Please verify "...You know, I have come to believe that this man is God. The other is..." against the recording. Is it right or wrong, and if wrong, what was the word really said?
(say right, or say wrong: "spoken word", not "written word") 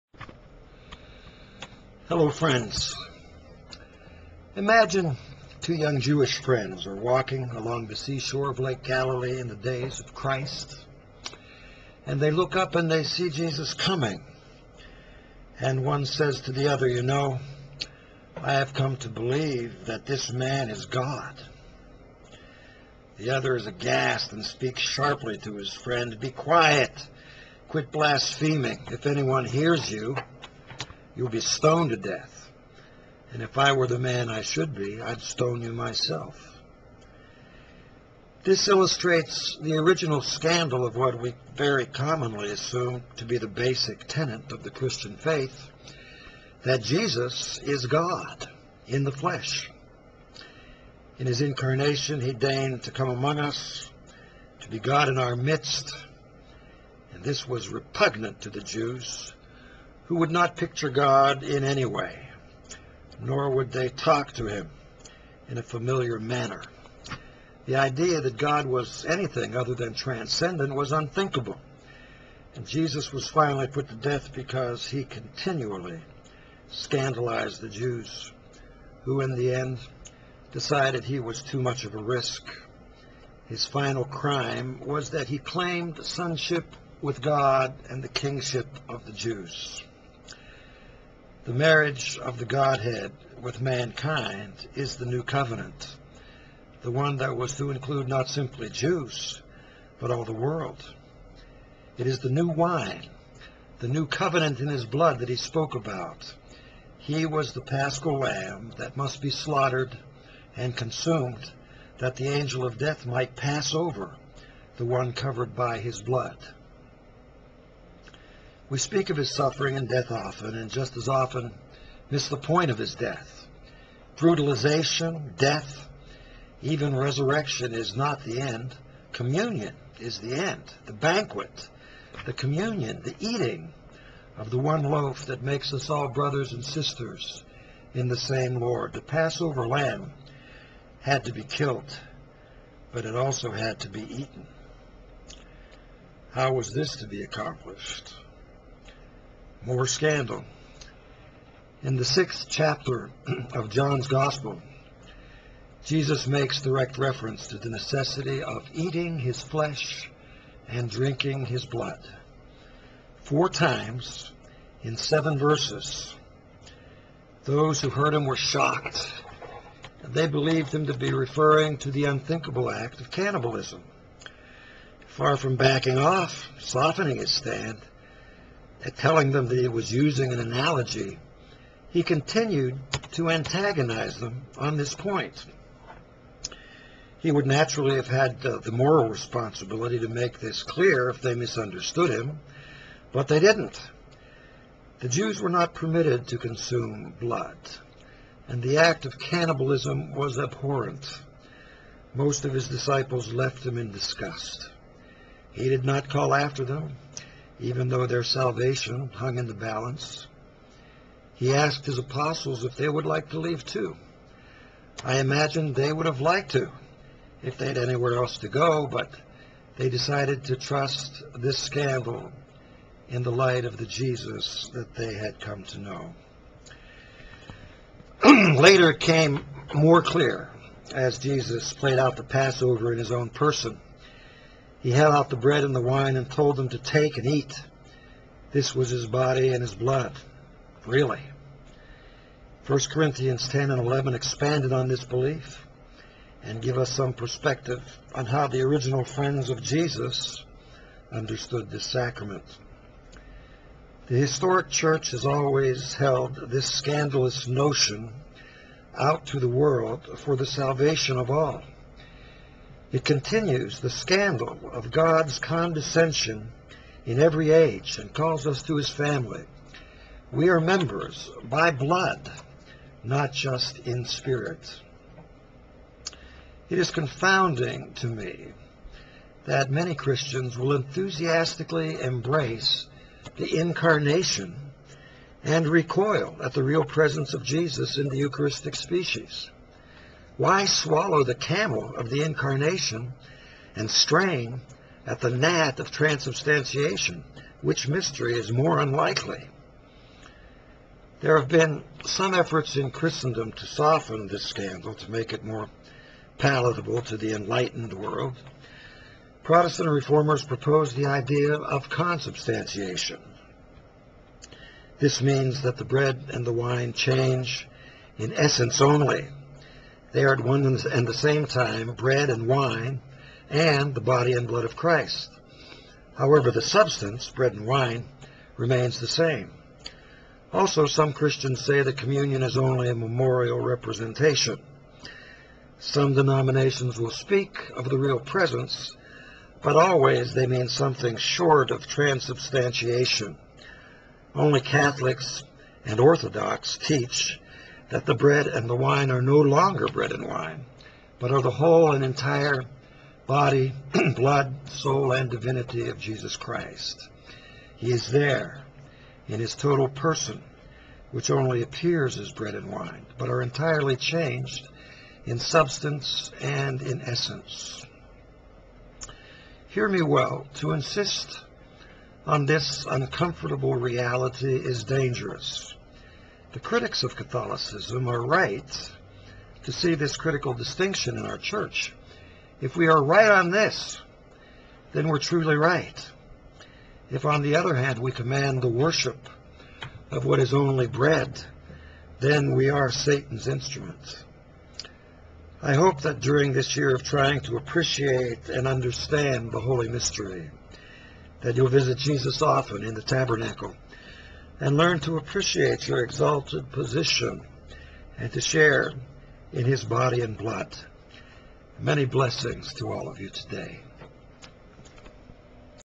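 right.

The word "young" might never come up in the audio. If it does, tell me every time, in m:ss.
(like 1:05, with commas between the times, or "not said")
0:05.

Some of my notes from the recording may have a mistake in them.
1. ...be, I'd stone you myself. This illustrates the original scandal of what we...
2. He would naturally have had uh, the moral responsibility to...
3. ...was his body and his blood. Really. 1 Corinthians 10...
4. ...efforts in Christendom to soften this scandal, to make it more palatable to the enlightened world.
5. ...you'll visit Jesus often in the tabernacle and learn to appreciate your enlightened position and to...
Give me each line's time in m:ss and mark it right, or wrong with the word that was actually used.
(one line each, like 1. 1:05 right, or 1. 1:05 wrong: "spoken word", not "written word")
1. 0:34 right
2. 3:07 right
3. 3:58 right
4. 5:02 right
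5. 6:41 wrong: "exalted", not "enlightened".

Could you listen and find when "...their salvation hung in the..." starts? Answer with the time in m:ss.
3:28.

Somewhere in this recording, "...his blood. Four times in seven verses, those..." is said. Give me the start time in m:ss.
2:41.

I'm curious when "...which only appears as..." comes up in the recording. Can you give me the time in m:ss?
6:01.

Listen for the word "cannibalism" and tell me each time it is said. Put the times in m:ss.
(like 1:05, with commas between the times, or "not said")
2:53, 3:19.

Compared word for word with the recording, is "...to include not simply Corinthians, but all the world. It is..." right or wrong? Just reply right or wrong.
wrong.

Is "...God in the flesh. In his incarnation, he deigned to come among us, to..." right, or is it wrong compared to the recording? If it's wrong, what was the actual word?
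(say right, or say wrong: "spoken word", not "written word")
right.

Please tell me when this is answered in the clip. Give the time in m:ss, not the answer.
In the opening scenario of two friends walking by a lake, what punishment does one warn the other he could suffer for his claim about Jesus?
0:31.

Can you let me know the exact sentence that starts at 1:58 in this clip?
We speak of his suffering and death often, and just as often miss the point of his death.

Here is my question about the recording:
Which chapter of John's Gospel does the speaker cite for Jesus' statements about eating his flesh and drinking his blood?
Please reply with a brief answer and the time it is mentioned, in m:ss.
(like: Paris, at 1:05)
Sixth chapter, at 2:32.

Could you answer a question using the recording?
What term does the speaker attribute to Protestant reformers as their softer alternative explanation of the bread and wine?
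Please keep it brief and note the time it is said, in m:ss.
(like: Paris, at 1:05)
Consubstantiation, at 5:11.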